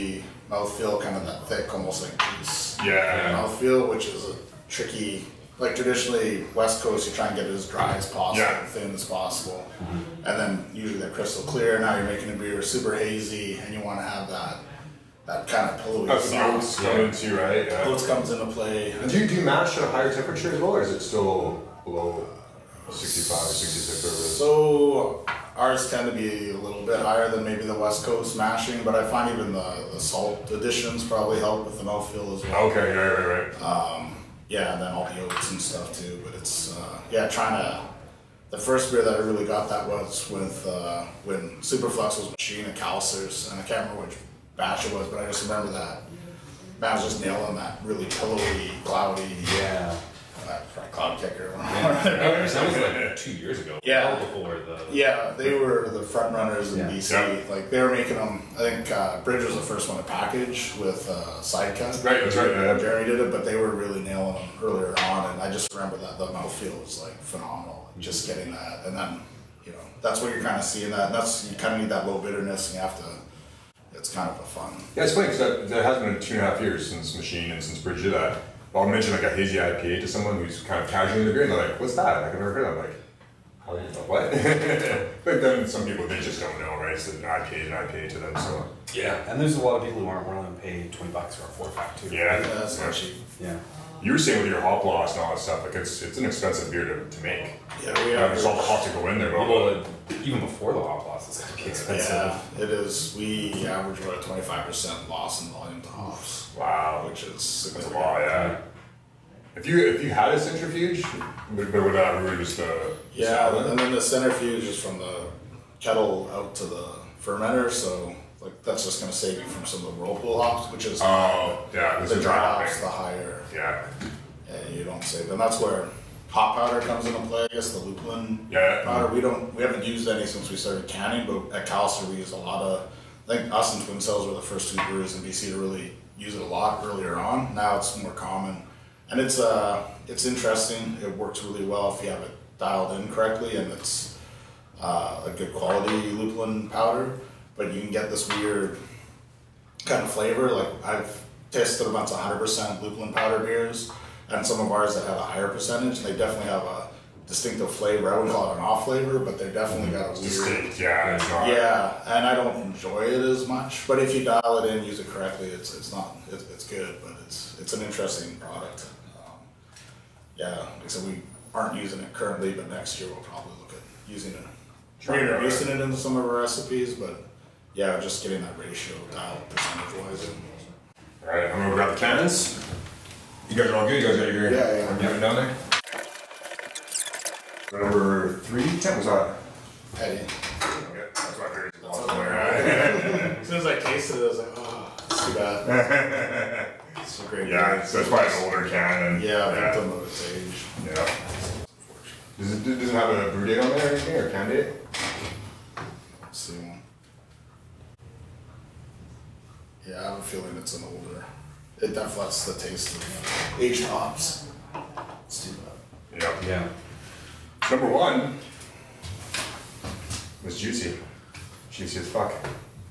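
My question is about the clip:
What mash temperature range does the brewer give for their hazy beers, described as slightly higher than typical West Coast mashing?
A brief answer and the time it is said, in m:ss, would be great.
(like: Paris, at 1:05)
65-66, at 0:22.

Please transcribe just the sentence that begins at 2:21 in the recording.
It works really well if you have it dialed in correctly, and it's uh, a good quality lupulin powder.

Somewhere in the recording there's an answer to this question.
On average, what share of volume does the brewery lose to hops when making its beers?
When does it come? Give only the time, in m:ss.
1:44.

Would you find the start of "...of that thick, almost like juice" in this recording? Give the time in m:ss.
0:01.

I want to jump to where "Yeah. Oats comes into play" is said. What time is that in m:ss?
0:17.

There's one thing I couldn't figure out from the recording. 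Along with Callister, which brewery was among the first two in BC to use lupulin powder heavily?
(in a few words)
Twin Sails.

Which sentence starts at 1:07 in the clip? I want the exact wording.
Like, just getting that, and then you know that's what you're kind of seeing that.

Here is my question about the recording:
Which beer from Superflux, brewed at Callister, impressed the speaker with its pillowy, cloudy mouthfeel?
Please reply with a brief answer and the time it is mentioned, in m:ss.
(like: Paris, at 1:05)
Cloud Kicker, at 0:50.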